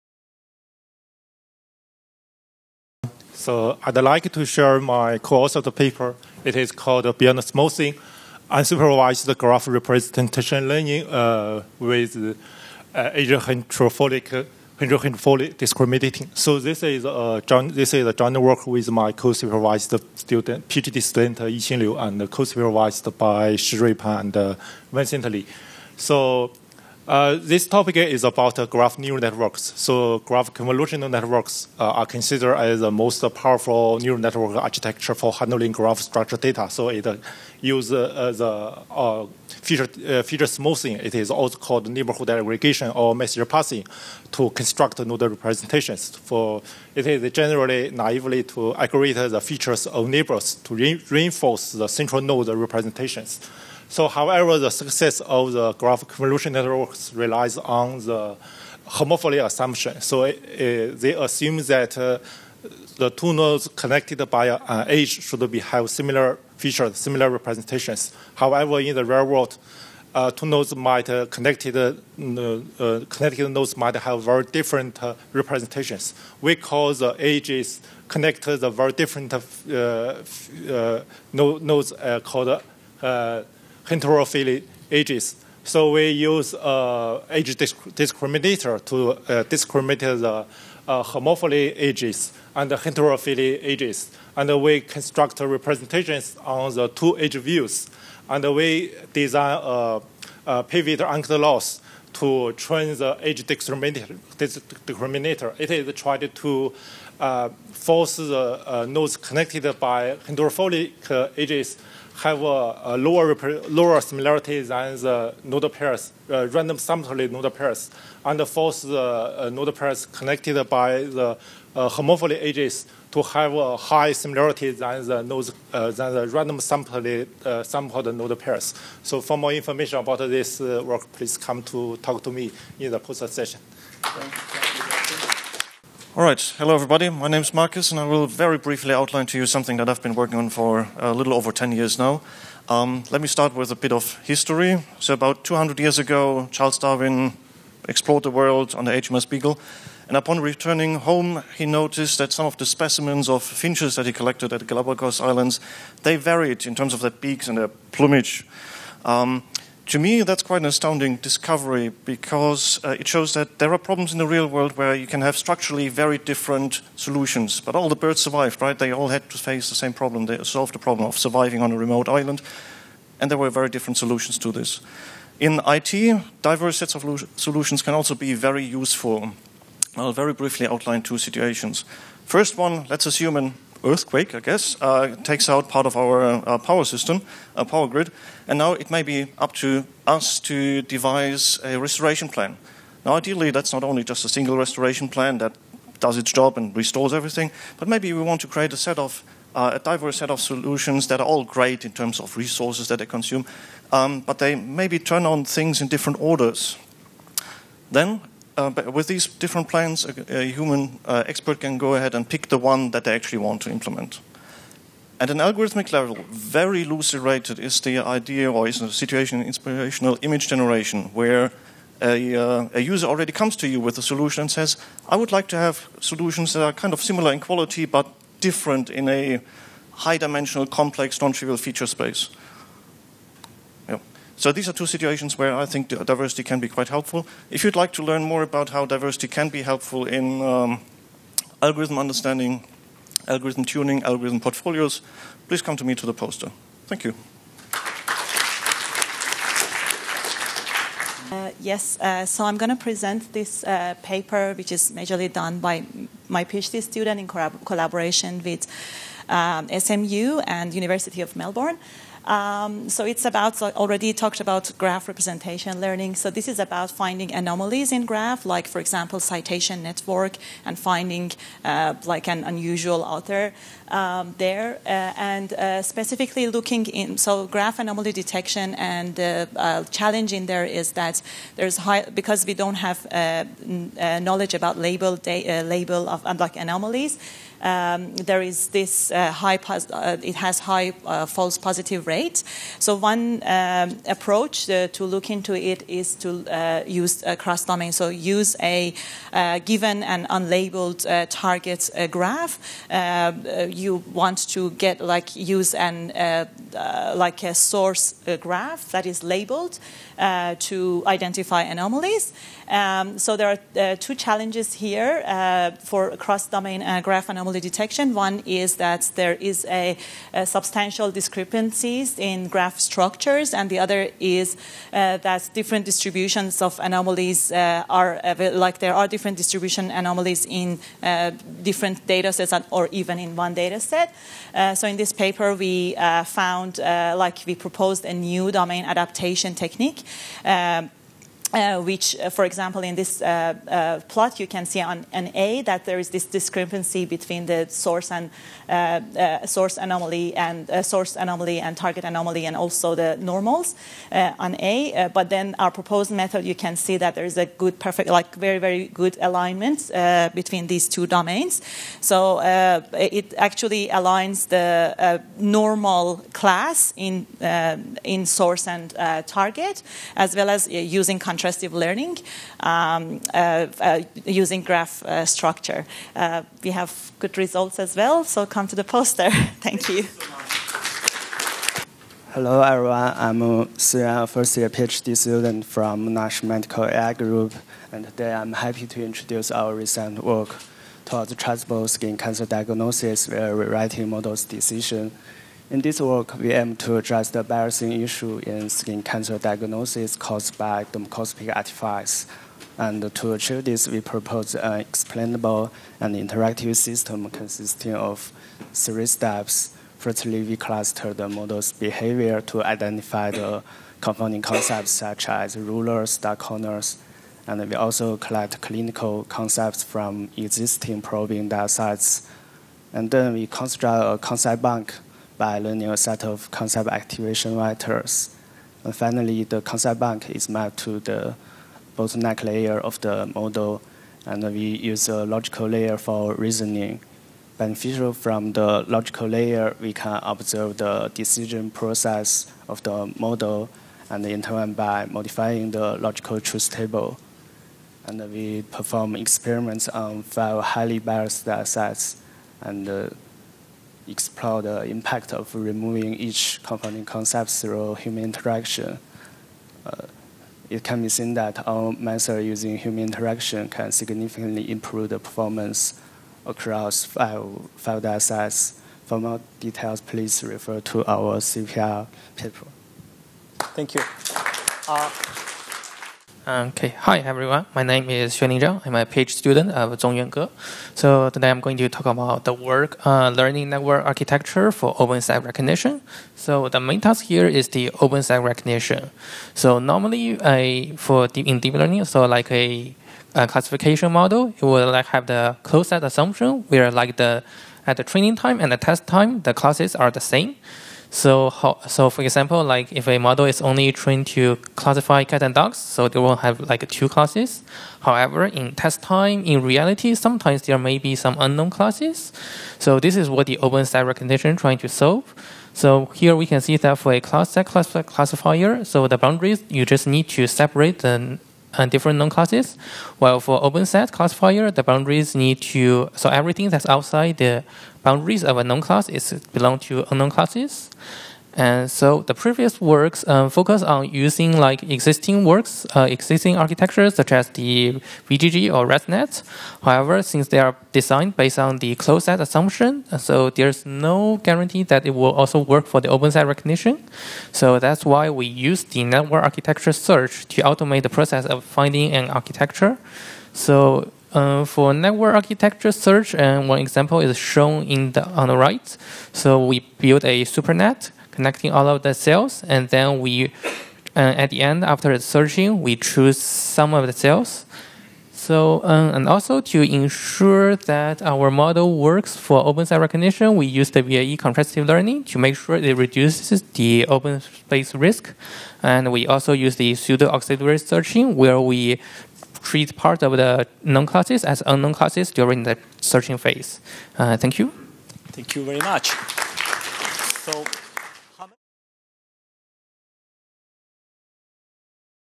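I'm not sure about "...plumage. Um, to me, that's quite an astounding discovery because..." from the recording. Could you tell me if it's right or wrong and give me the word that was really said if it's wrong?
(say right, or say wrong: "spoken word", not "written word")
right.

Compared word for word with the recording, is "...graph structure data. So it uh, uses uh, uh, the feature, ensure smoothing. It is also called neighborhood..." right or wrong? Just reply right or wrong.
wrong.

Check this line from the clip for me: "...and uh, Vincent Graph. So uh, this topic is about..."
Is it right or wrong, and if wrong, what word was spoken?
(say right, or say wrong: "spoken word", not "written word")
wrong: "Lee", not "Graph".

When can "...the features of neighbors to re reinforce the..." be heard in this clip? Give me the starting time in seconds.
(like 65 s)
49 s.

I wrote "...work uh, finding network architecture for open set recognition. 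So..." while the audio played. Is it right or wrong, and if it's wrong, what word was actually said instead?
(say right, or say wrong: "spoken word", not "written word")
wrong: "learning", not "finding".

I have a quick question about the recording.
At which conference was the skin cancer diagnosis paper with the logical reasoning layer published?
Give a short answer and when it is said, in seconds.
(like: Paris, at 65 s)
CVPR, at 471 s.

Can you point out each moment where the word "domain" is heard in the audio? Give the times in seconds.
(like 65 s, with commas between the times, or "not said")
297 s, 316 s, 338 s, 361 s.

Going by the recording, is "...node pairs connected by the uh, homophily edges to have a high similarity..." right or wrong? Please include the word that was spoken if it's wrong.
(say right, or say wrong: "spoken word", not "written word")
right.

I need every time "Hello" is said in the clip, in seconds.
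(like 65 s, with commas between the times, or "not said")
136 s, 382 s.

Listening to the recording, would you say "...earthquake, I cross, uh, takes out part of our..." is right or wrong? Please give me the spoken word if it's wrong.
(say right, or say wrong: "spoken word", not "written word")
wrong: "guess", not "cross".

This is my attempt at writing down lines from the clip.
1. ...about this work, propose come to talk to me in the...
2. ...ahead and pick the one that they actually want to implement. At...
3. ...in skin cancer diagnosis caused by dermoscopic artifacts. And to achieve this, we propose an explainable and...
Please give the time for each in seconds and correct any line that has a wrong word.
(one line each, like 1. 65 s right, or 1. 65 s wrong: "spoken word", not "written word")
1. 129 s wrong: "please", not "propose"
2. 211 s right
3. 398 s right.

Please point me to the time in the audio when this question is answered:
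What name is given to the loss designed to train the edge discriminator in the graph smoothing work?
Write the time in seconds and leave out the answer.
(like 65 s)
100 s.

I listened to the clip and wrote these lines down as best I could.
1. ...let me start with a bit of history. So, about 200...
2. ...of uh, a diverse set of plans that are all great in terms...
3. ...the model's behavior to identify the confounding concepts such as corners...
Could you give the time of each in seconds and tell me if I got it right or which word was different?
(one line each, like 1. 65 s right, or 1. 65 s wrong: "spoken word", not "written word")
1. 143 s right
2. 198 s wrong: "solutions", not "plans"
3. 411 s wrong: "rulers", not "corners".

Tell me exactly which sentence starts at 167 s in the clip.
But all the birds survived, right?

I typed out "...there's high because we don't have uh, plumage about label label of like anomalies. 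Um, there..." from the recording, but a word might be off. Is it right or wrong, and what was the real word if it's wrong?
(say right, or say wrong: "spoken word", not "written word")
wrong: "knowledge", not "plumage".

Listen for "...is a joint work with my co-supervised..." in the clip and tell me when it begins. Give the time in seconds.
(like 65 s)
17 s.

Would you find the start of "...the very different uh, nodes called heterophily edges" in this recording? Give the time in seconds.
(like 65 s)
78 s.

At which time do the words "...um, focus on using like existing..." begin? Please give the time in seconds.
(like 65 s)
533 s.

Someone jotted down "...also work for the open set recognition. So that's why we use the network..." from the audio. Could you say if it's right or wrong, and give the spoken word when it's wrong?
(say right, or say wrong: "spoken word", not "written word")
right.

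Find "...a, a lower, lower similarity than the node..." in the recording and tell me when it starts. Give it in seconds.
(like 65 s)
112 s.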